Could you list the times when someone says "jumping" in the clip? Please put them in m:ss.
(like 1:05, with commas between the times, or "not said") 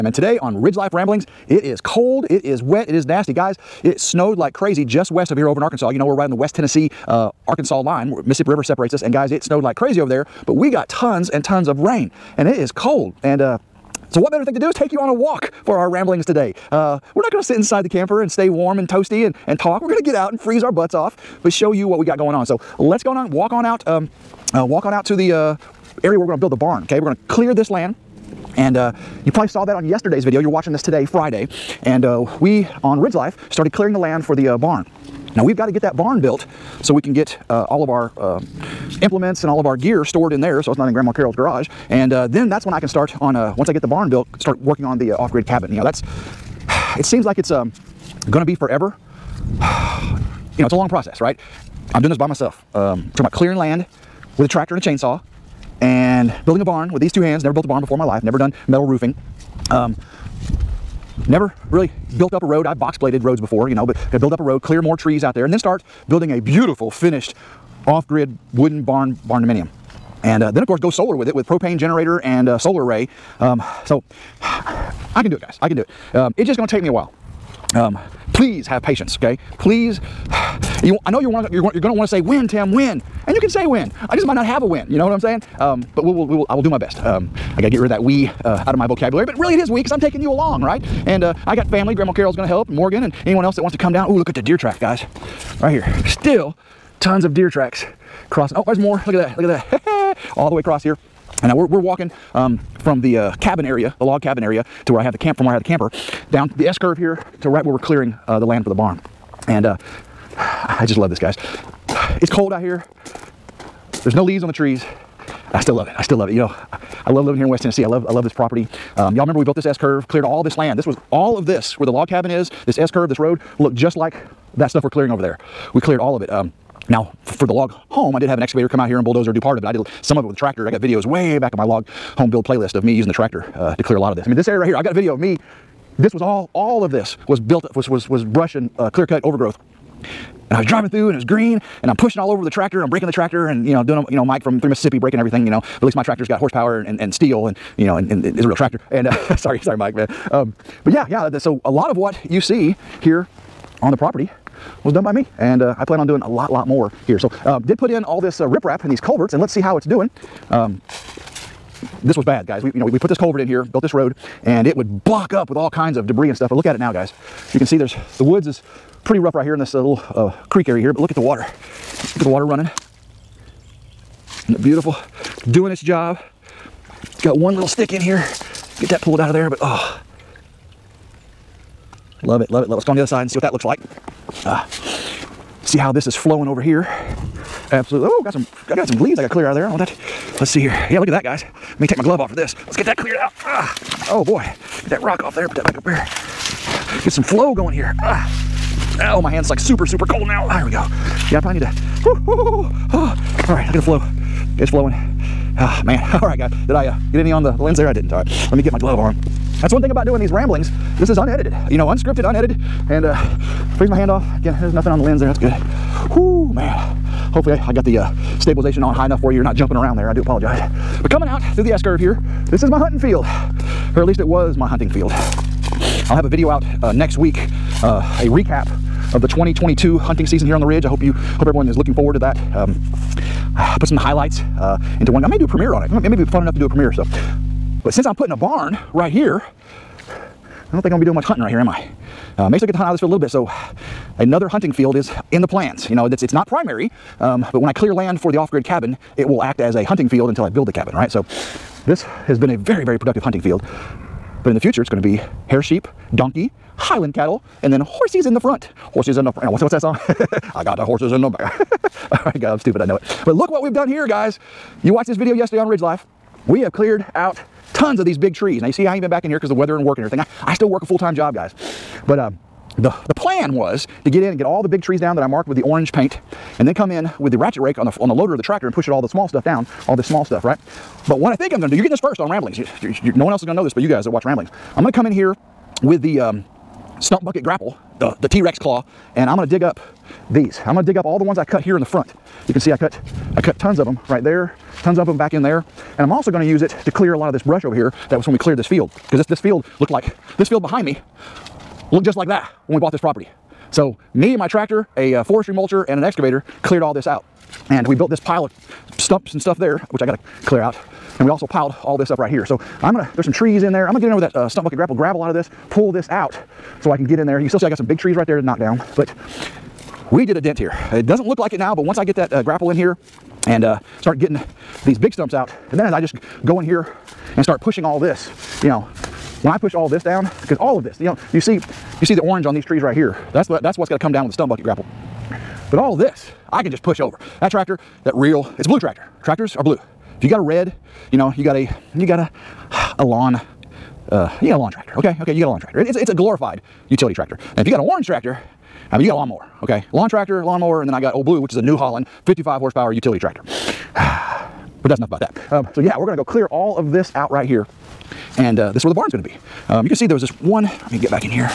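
3:39.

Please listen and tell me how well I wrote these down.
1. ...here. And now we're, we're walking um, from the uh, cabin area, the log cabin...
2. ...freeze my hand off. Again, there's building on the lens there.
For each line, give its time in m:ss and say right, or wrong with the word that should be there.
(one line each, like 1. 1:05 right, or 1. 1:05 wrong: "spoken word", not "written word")
1. 1:40 right
2. 3:33 wrong: "nothing", not "building".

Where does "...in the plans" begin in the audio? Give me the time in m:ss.
4:05.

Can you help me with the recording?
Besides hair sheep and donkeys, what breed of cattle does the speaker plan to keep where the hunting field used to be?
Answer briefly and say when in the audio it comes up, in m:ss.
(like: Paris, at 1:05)
Highland cattle, at 4:16.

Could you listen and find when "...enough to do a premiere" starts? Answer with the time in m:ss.
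3:56.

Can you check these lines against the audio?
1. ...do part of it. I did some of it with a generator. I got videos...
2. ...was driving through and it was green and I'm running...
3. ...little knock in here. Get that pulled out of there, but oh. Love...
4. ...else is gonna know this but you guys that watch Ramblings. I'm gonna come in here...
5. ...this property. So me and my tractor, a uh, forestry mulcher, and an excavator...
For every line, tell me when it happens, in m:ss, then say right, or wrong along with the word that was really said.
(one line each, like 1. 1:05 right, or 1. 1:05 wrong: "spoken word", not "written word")
1. 2:09 wrong: "tractor", not "generator"
2. 2:20 wrong: "pushing", not "running"
3. 2:57 wrong: "stick", not "knock"
4. 4:43 right
5. 5:02 right.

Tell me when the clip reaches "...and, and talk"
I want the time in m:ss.
0:19.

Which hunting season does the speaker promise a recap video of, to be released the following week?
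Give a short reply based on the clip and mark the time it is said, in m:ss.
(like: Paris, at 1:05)
2022, at 3:49.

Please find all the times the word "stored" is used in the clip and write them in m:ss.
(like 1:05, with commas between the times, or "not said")
0:40.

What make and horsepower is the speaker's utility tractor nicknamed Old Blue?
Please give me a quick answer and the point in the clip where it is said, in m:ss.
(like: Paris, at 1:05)
New Holland, 55 horsepower, at 5:51.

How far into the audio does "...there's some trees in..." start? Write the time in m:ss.
5:13.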